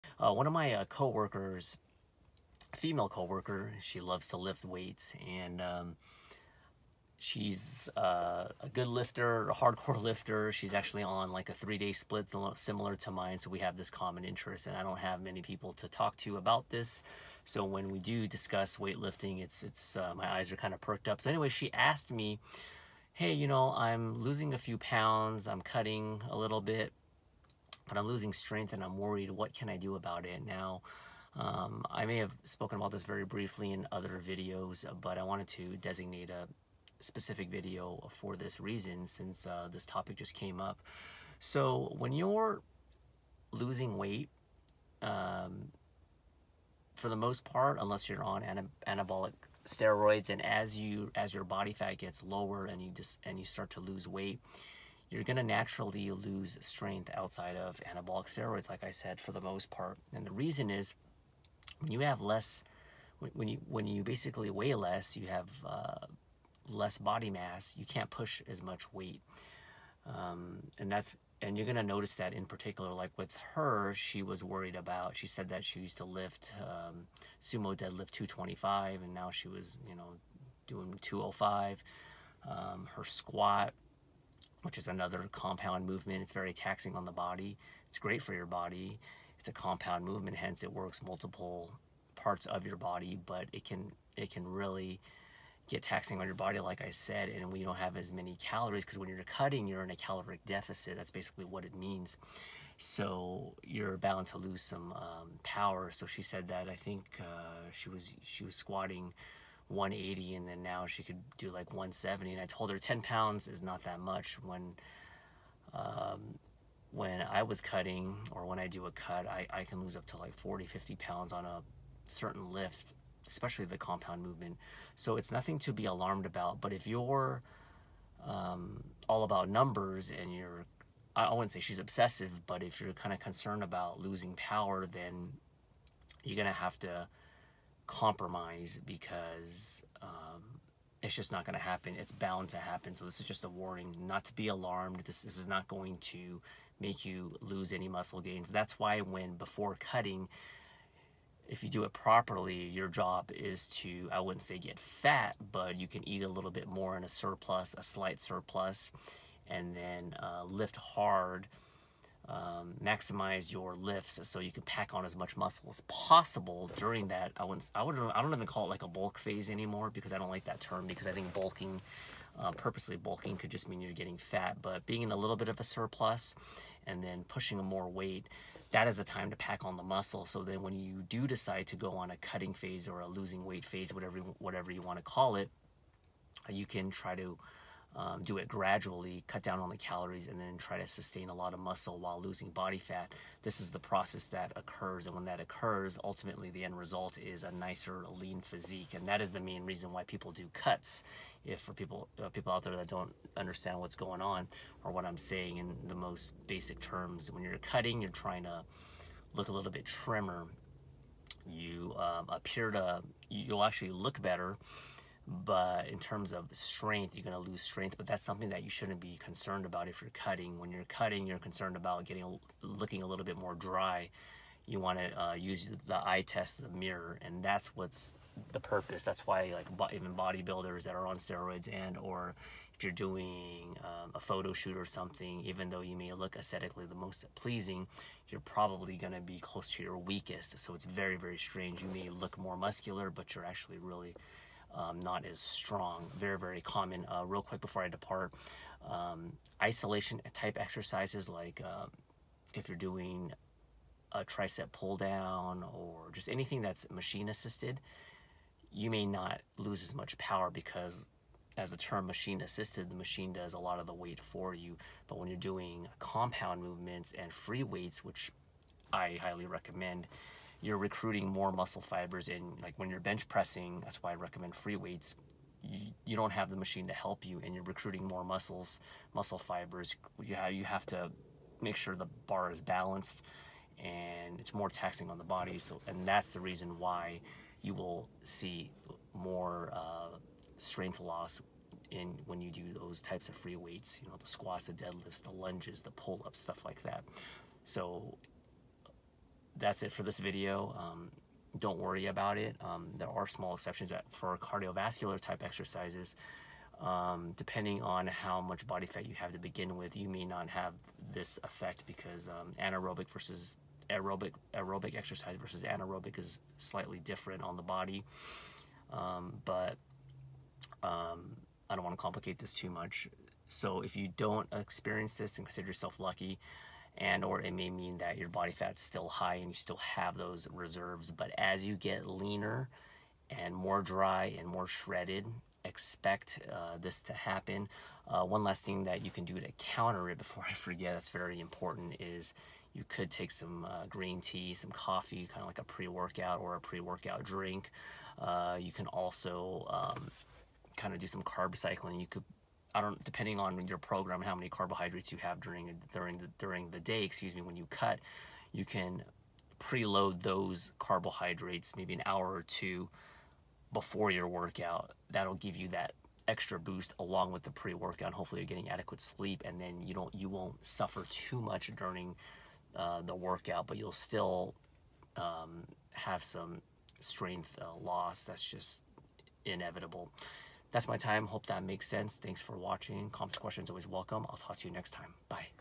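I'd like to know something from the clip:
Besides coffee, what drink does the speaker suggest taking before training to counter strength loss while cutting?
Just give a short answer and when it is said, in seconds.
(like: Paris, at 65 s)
green tea, at 343 s.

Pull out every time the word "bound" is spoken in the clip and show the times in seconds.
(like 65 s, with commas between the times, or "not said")
103 s, 142 s.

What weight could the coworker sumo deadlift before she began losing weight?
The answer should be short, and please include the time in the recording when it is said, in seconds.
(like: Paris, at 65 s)
225, at 78 s.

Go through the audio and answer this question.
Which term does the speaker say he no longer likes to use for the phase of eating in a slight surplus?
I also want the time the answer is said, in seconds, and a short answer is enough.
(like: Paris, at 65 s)
bulk phase, at 168 s.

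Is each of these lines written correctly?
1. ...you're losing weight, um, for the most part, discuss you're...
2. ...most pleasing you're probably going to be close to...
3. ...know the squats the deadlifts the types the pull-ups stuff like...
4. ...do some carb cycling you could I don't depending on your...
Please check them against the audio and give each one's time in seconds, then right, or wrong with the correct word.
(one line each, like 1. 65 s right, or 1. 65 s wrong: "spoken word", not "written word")
1. 42 s wrong: "unless", not "discuss"
2. 236 s right
3. 294 s wrong: "lunges", not "types"
4. 350 s right.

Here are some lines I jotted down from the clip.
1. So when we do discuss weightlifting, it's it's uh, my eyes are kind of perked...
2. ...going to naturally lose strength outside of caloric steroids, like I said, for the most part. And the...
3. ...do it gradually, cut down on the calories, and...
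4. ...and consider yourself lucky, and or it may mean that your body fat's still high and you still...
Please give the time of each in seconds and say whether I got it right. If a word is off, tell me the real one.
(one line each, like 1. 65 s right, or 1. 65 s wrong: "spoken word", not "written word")
1. 17 s right
2. 55 s wrong: "anabolic", not "caloric"
3. 188 s right
4. 325 s right.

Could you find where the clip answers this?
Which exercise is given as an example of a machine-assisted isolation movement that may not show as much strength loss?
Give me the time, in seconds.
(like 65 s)
254 s.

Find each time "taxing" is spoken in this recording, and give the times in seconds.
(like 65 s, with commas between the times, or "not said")
86 s, 95 s, 284 s.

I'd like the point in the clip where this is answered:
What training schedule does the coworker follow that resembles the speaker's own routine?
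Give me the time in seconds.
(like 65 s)
11 s.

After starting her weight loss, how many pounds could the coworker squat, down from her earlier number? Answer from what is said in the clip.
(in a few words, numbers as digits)
170.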